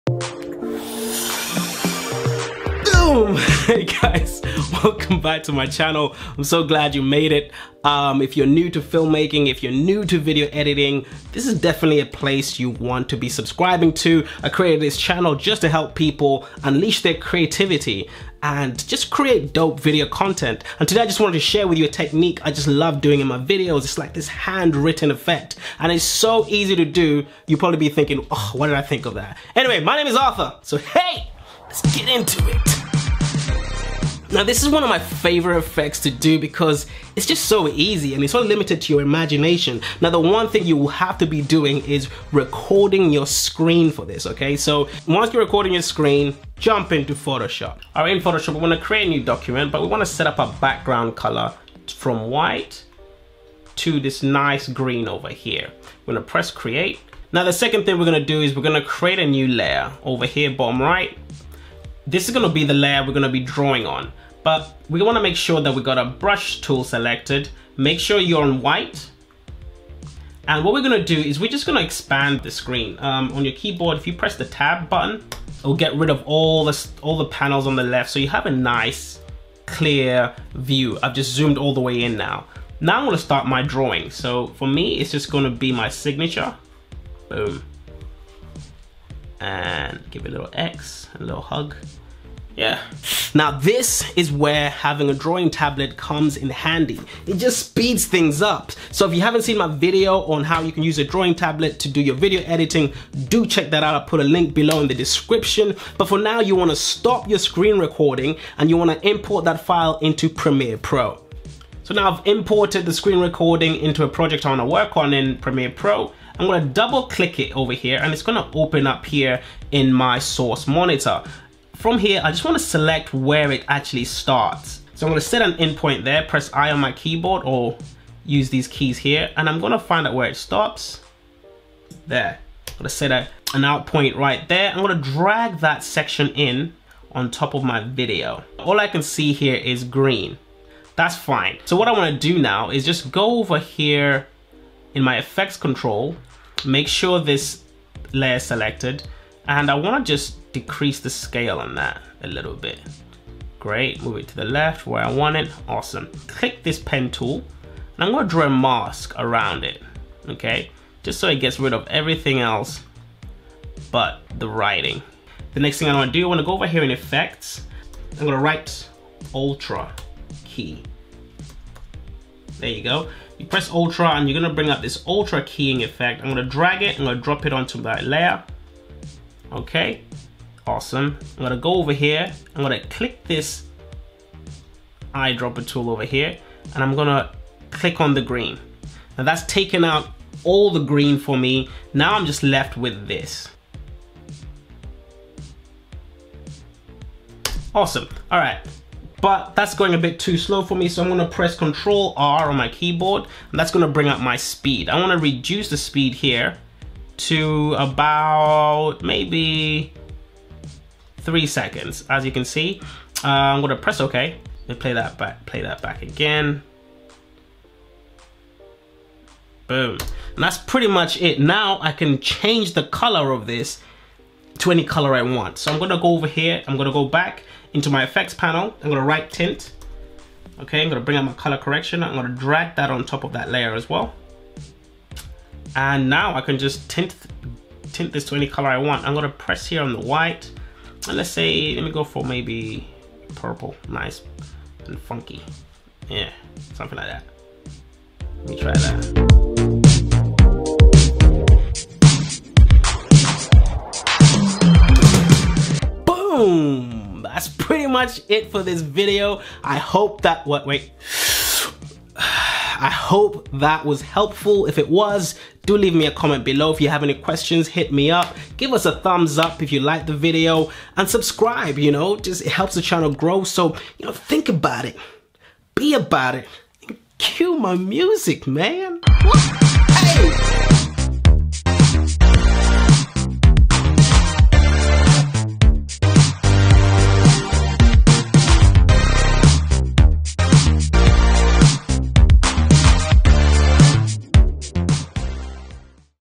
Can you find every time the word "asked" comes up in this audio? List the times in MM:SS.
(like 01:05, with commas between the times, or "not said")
not said.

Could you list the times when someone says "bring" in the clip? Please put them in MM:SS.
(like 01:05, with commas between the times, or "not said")
02:54, 03:23, 03:51.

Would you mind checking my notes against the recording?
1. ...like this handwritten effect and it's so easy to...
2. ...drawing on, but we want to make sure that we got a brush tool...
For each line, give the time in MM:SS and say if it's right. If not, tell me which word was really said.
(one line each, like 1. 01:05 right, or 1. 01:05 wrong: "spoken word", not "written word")
1. 00:23 right
2. 01:03 right.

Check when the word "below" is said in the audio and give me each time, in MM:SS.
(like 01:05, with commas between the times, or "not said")
01:44, 04:26.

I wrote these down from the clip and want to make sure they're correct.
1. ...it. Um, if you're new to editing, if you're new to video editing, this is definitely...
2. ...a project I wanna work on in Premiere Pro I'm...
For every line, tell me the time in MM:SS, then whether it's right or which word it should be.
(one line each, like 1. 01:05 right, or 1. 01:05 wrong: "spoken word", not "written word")
1. 00:07 wrong: "filmmaking", not "editing"
2. 01:54 right.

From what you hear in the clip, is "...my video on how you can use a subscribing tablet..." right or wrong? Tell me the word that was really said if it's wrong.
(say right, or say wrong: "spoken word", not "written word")
wrong: "drawing", not "subscribing".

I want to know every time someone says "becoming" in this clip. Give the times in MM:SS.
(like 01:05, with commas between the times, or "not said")
not said.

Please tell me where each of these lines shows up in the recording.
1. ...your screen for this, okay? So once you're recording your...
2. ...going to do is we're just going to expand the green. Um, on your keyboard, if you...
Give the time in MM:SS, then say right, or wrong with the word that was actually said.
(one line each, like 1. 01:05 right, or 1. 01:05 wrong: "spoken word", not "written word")
1. 00:43 right
2. 01:10 wrong: "screen", not "green".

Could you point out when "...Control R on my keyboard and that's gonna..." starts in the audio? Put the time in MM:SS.
03:21.